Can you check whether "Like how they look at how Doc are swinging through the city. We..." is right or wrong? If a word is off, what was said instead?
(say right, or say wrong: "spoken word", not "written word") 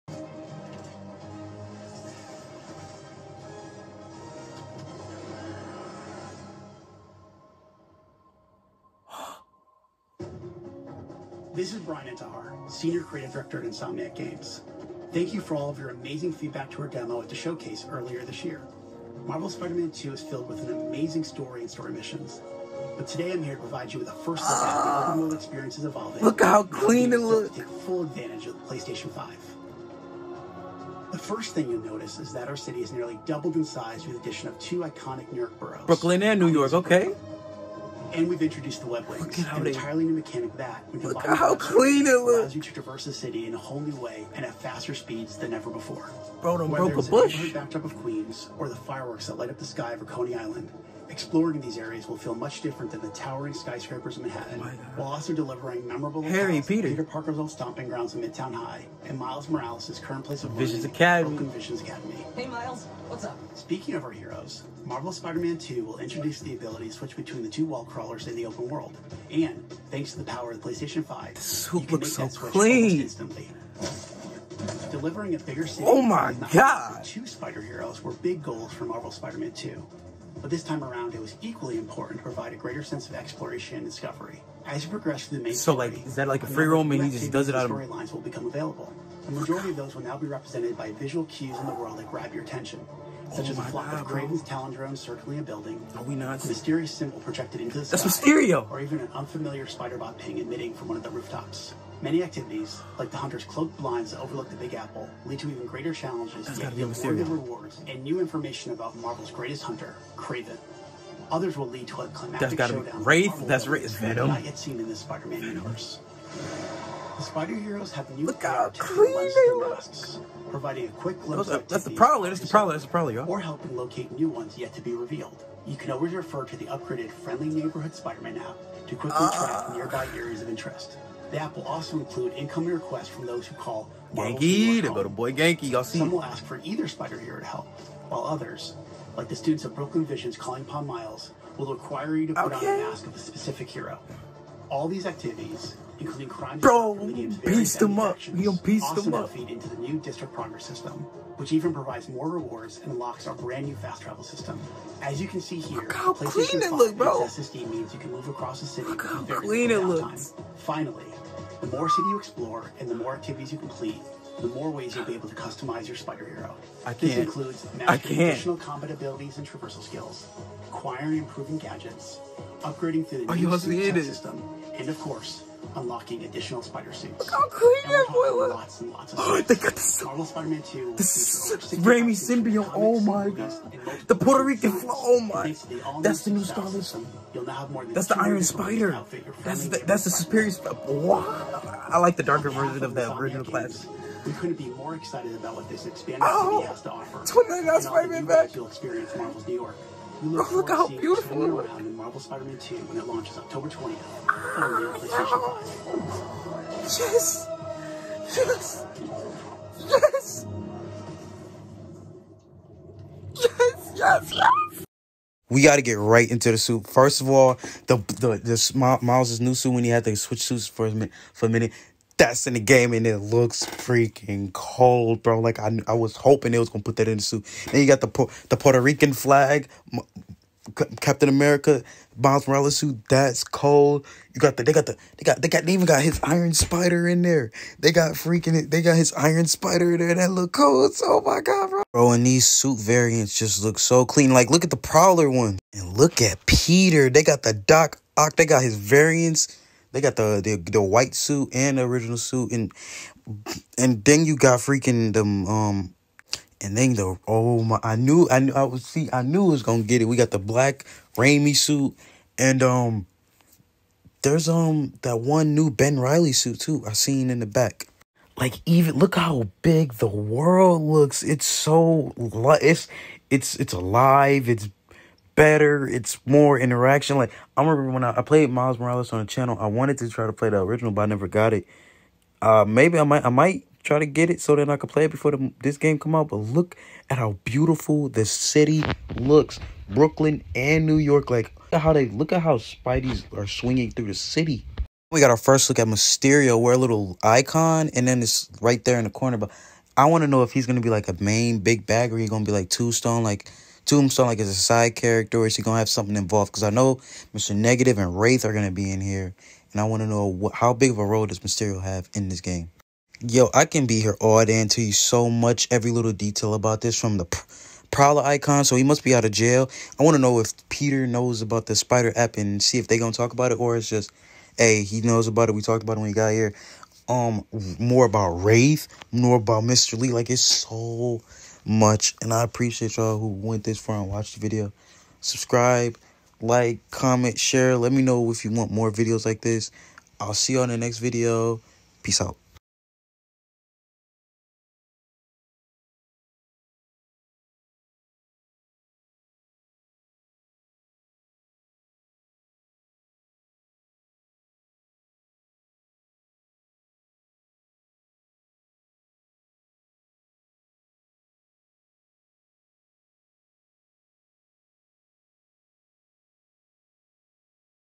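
wrong: "Spideys", not "Doc".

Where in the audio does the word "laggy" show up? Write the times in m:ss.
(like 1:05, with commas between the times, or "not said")
not said.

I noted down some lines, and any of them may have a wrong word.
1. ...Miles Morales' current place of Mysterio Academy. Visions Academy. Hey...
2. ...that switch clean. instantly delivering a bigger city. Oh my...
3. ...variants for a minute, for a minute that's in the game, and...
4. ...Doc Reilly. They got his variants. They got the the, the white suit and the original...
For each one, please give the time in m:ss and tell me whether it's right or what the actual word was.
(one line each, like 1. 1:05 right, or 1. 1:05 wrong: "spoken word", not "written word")
1. 0:59 wrong: "Visions", not "Mysterio"
2. 1:12 right
3. 3:40 wrong: "suits", not "variants"
4. 4:07 wrong: "Ock", not "Reilly".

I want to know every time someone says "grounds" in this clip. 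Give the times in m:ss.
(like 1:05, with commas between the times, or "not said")
0:57.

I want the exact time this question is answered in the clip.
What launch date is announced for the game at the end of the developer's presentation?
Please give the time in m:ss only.
3:23.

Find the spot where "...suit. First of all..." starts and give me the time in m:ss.
3:36.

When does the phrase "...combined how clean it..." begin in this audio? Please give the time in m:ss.
0:41.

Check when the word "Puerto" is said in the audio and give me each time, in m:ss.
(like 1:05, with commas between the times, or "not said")
3:04, 3:48.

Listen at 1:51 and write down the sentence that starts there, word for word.
Others will lead to a climactic That's gotta showdown.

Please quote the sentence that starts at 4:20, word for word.
We got the black Raimi suit, and um, there's um that one new Ben Reilly suit too.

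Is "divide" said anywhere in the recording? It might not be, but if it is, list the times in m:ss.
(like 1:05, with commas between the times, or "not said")
not said.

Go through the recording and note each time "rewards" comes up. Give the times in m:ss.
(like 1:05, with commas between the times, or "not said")
1:47, 2:32.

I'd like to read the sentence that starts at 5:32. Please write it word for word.
And I appreciate y'all who went this far and watched the video.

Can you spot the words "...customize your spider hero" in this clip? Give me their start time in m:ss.
2:45.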